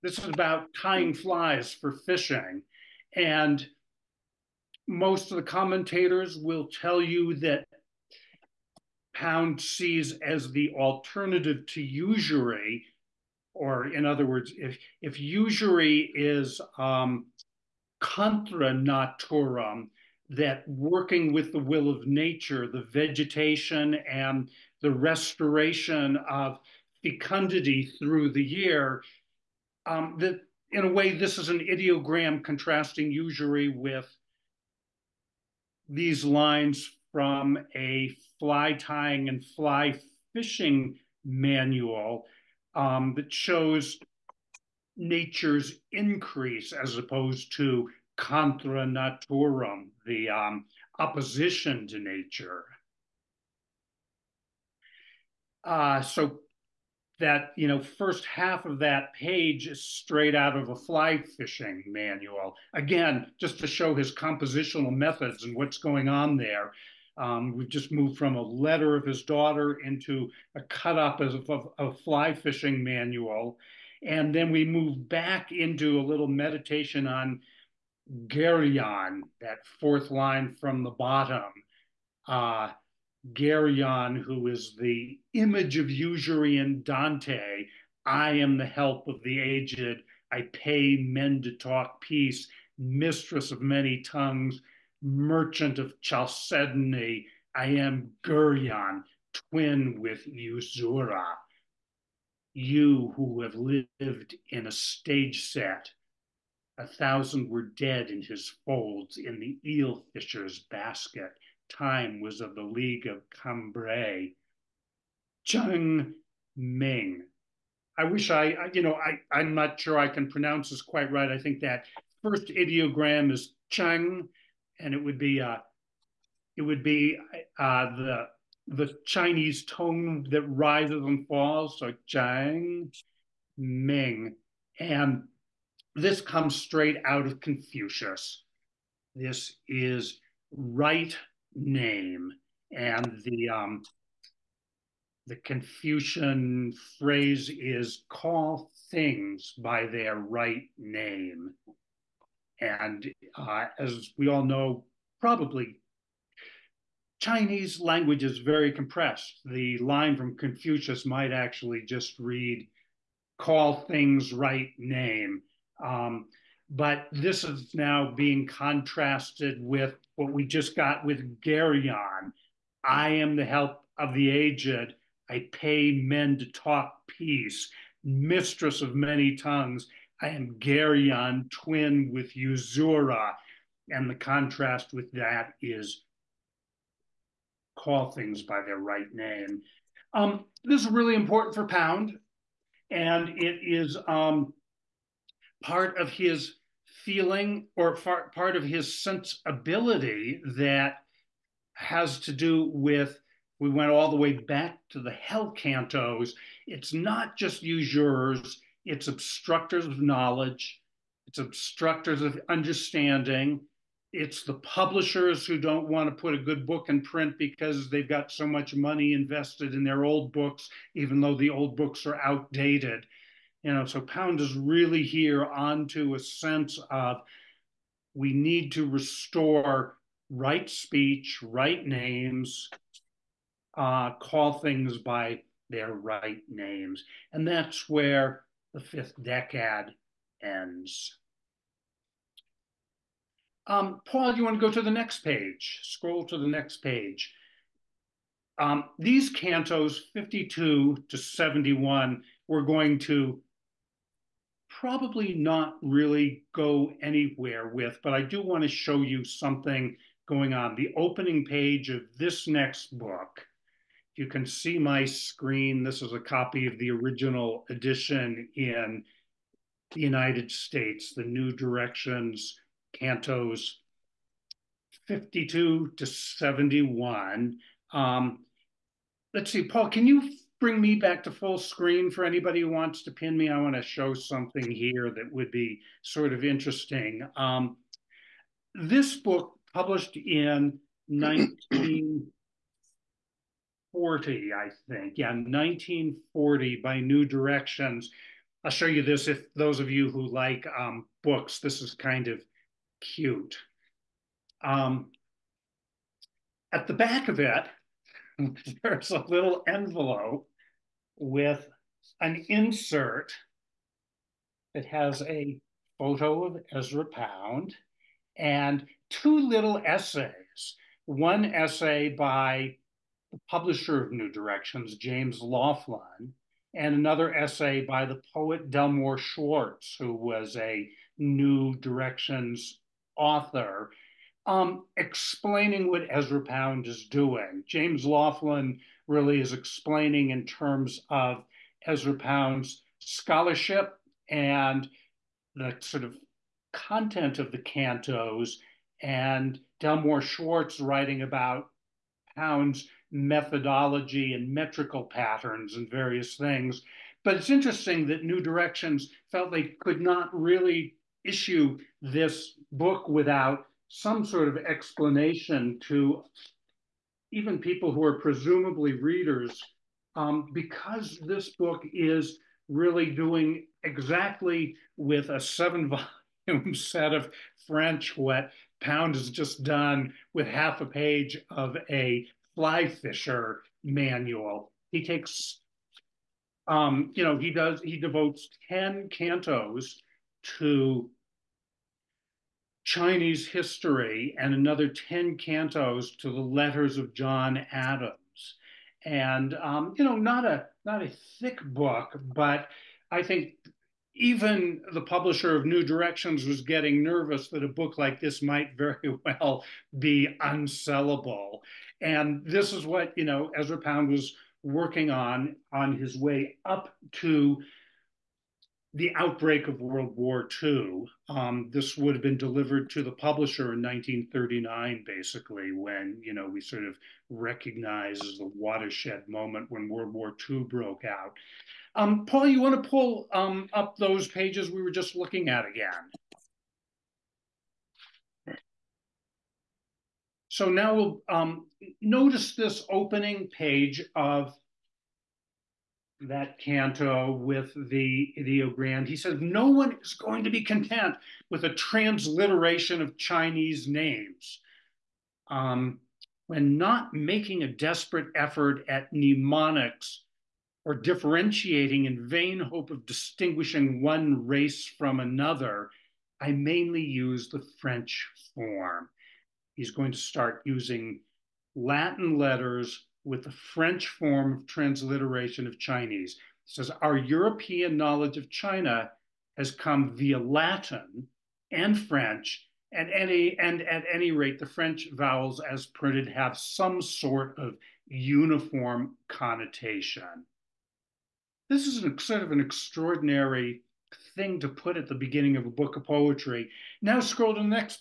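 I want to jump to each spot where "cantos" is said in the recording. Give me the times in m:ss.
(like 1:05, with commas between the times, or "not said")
3:25, 4:09, 4:32, 5:47, 6:29, 6:35, 7:26.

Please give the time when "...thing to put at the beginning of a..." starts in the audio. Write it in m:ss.
8:14.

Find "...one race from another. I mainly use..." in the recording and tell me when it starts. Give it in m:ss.
7:44.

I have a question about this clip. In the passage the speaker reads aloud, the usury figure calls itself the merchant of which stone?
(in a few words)
Chalcedony.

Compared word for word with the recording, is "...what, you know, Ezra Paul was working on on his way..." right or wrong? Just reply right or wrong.
wrong.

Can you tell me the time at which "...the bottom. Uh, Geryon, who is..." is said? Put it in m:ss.
1:20.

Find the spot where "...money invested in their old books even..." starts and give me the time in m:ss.
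3:38.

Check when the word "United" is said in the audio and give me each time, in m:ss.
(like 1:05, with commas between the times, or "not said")
4:30.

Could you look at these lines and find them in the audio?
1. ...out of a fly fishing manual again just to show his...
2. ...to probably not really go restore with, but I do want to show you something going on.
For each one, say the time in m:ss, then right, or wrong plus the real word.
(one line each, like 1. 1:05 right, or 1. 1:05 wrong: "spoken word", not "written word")
1. 1:00 right
2. 4:12 wrong: "anywhere", not "restore".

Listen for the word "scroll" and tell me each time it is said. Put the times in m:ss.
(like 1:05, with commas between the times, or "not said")
4:05, 8:17.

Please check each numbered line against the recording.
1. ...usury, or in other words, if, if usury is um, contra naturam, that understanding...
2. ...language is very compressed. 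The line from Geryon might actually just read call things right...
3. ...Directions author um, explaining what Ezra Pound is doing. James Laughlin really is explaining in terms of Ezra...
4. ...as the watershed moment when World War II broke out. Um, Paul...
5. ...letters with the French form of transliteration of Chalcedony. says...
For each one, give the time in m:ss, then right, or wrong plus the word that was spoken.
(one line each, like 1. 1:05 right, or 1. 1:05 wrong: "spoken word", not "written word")
1. 0:11 wrong: "working", not "understanding"
2. 2:37 wrong: "Confucius", not "Geryon"
3. 5:31 right
4. 7:08 right
5. 7:52 wrong: "Chinese", not "Chalcedony".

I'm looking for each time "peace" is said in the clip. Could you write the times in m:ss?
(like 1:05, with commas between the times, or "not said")
1:32, 2:57.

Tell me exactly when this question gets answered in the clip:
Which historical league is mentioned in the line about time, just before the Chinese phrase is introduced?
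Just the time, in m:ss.
1:52.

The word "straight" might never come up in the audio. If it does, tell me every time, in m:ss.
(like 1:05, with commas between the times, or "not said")
0:59, 2:16.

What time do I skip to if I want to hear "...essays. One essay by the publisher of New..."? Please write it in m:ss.
5:19.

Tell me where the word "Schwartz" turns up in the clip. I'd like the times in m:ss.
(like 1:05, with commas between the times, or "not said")
5:29, 5:50.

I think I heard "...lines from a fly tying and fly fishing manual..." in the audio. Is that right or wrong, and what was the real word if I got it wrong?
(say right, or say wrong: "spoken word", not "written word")
right.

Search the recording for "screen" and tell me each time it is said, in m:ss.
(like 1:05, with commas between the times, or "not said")
4:25, 4:41.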